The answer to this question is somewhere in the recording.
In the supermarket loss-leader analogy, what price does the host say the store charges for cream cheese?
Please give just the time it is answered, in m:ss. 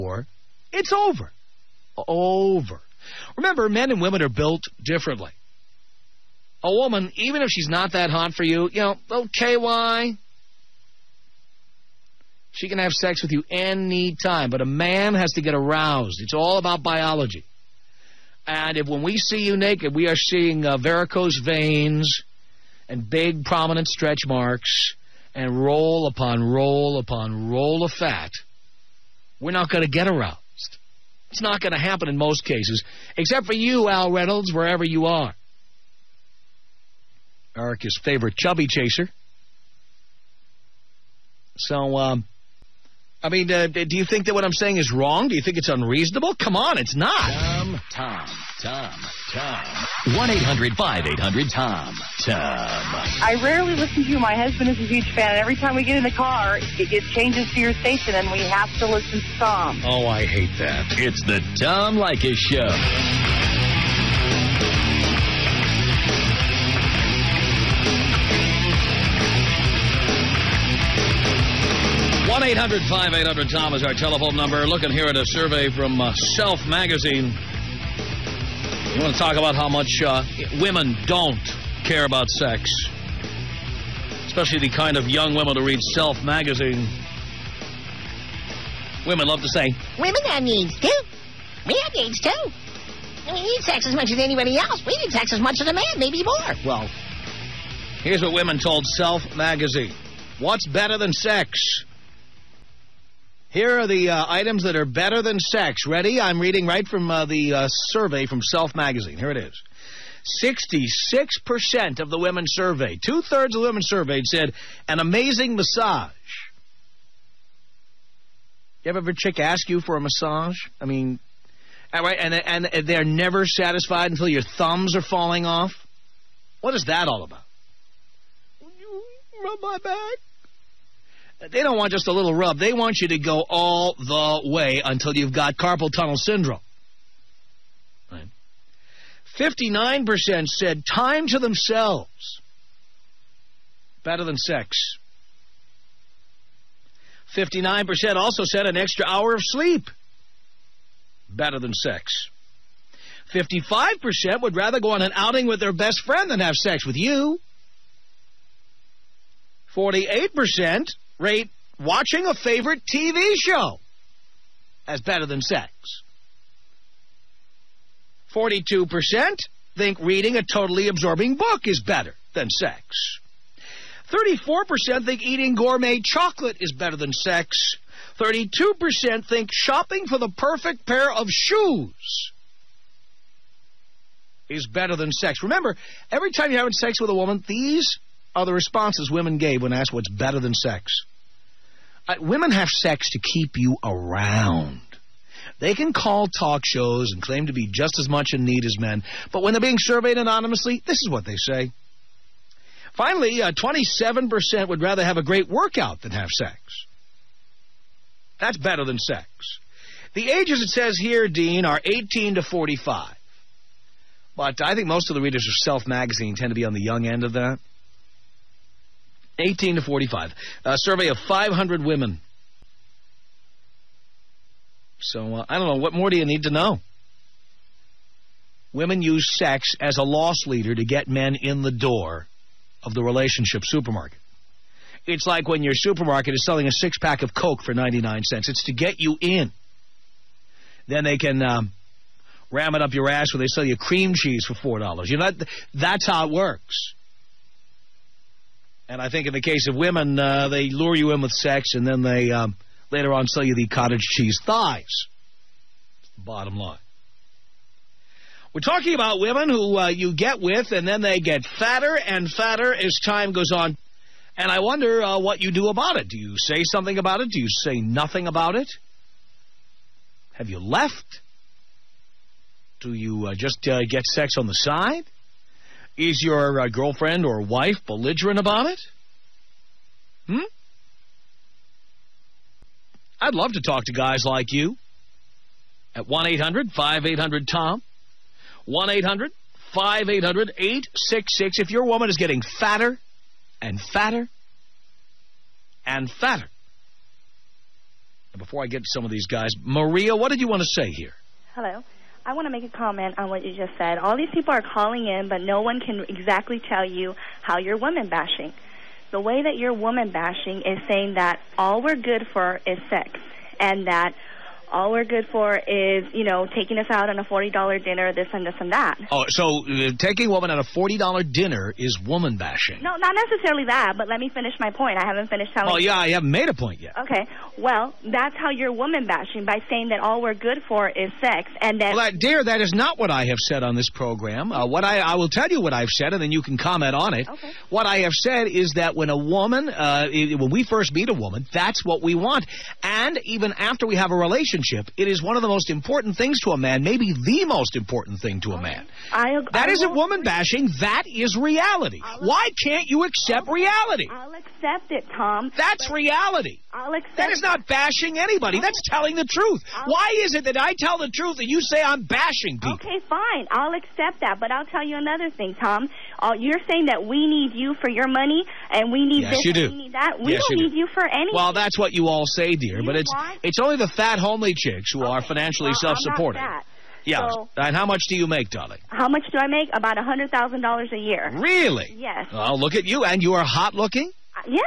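4:04.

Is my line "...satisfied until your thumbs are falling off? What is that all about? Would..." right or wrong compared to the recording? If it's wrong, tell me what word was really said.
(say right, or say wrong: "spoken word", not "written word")
right.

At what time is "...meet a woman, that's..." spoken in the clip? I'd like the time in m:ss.
5:40.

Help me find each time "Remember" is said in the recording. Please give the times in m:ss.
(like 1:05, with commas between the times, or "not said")
0:03, 3:05.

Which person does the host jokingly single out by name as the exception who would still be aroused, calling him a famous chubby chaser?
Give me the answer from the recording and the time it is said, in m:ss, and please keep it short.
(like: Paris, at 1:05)
Al Reynolds, at 0:33.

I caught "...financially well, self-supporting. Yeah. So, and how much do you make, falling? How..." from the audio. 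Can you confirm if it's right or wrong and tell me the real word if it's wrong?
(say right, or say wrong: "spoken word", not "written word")
wrong: "darling", not "falling".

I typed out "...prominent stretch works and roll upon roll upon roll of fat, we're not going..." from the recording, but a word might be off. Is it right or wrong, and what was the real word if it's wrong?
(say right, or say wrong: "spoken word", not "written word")
wrong: "marks", not "works".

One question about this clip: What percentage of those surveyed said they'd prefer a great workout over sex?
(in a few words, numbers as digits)
27%.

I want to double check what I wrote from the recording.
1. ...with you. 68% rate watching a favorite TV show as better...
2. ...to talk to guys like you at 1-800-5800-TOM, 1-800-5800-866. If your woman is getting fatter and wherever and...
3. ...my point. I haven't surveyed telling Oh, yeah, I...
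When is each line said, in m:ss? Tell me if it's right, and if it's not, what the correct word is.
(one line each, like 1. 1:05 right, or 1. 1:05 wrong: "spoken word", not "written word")
1. 2:36 wrong: "48", not "68"
2. 4:43 wrong: "fatter", not "wherever"
3. 5:24 wrong: "finished", not "surveyed".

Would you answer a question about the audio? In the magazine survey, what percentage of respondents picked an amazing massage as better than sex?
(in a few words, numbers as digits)
66%.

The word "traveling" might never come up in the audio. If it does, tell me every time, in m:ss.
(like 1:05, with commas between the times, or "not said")
not said.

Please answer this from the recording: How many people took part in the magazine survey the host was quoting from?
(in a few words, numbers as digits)
500.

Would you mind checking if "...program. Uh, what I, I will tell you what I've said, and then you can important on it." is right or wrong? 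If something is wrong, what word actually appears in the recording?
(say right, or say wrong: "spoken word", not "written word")
wrong: "comment", not "important".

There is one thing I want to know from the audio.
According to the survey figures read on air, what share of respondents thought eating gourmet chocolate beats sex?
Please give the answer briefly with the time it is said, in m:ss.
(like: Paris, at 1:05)
34%, at 2:54.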